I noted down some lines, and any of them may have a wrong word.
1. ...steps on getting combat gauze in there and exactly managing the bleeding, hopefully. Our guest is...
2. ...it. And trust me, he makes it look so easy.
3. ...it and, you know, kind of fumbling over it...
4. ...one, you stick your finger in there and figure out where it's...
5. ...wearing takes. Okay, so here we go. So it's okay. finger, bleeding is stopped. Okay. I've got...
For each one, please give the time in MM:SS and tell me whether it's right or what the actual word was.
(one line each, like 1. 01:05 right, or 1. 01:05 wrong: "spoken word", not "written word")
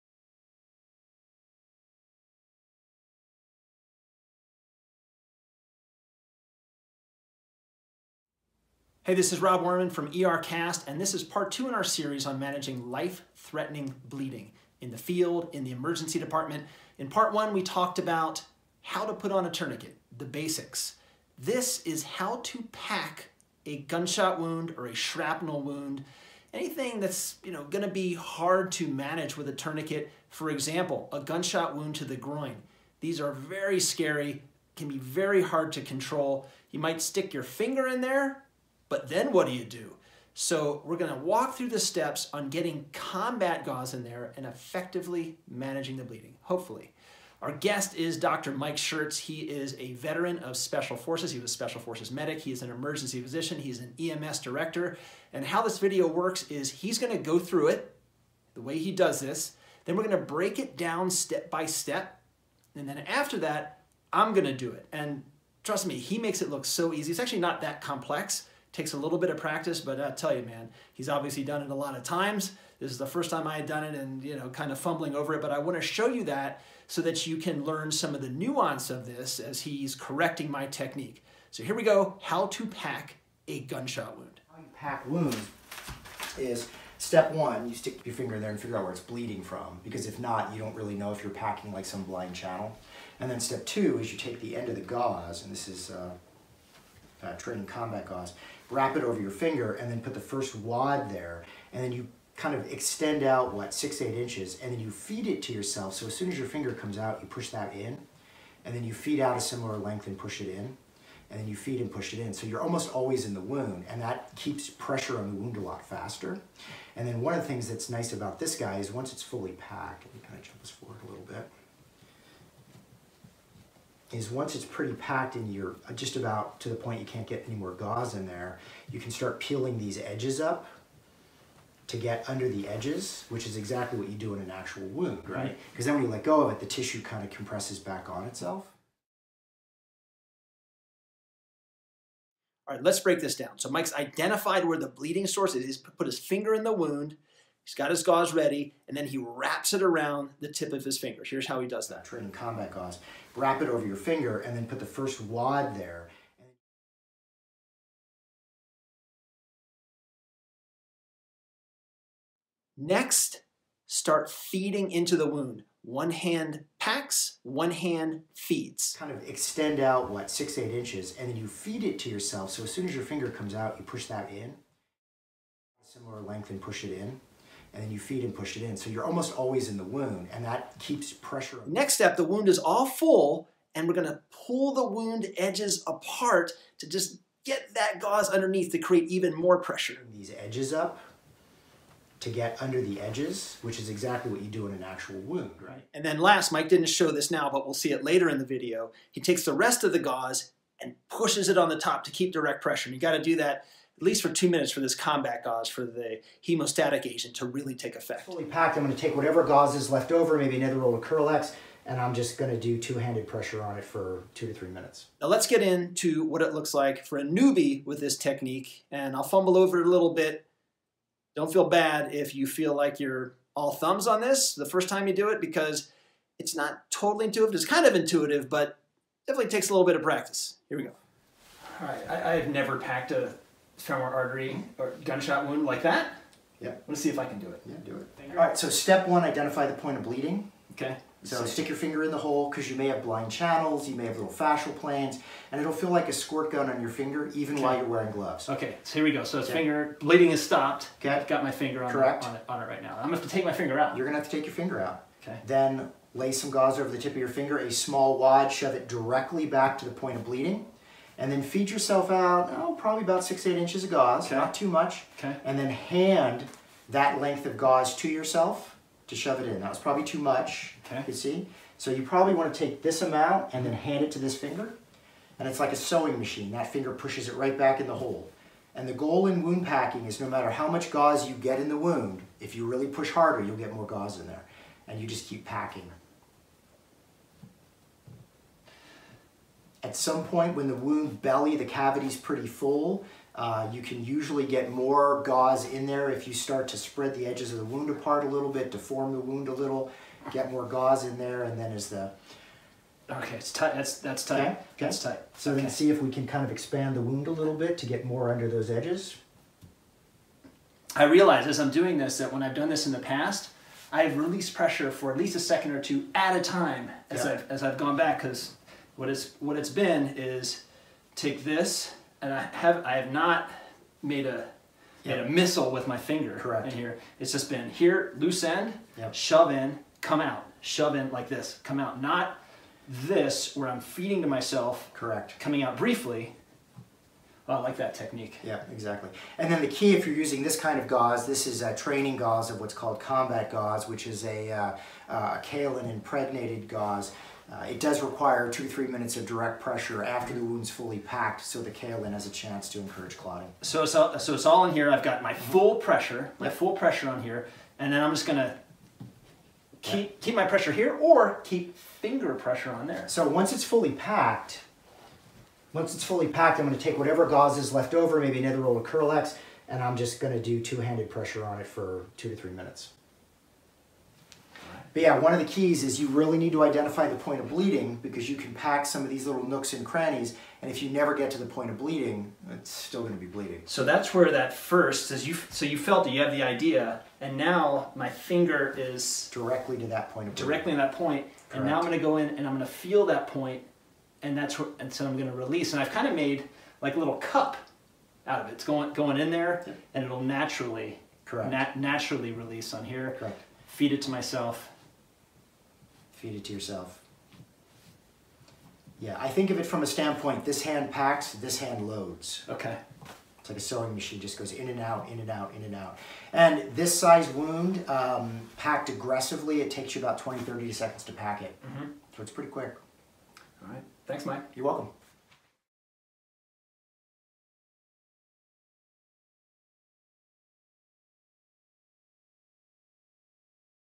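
1. 00:41 wrong: "effectively", not "exactly"
2. 01:04 right
3. 01:13 right
4. 01:27 right
5. 04:07 wrong: "gloves", not "takes".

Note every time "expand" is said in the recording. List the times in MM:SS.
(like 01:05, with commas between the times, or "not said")
05:06.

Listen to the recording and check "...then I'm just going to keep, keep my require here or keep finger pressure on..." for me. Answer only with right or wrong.
wrong.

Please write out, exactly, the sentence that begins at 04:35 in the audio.
And it's like a sewing machine.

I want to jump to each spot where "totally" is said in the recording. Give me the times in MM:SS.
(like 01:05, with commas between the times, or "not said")
03:46.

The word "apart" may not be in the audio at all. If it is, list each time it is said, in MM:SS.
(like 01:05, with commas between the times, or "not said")
03:05, 04:57.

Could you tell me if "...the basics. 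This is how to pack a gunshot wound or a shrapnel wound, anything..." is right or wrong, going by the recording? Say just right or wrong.
right.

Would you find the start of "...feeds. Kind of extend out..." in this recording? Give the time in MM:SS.
02:48.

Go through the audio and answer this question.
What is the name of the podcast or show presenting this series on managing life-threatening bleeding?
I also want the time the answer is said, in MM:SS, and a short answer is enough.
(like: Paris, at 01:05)
ERCast, at 00:10.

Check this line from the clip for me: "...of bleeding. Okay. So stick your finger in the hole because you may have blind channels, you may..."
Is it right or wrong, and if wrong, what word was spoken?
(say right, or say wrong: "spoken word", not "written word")
right.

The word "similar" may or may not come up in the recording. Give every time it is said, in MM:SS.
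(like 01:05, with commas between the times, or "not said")
01:49, 02:55.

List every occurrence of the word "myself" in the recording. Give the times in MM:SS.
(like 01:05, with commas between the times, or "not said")
05:34, 06:44.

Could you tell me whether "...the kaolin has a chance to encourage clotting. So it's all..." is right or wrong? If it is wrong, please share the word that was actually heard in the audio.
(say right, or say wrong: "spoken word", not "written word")
right.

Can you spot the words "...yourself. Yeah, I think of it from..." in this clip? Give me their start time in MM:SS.
06:46.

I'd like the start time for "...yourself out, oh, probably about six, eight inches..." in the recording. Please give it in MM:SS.
04:21.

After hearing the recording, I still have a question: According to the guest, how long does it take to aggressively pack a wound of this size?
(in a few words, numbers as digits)
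20 to 30 seconds.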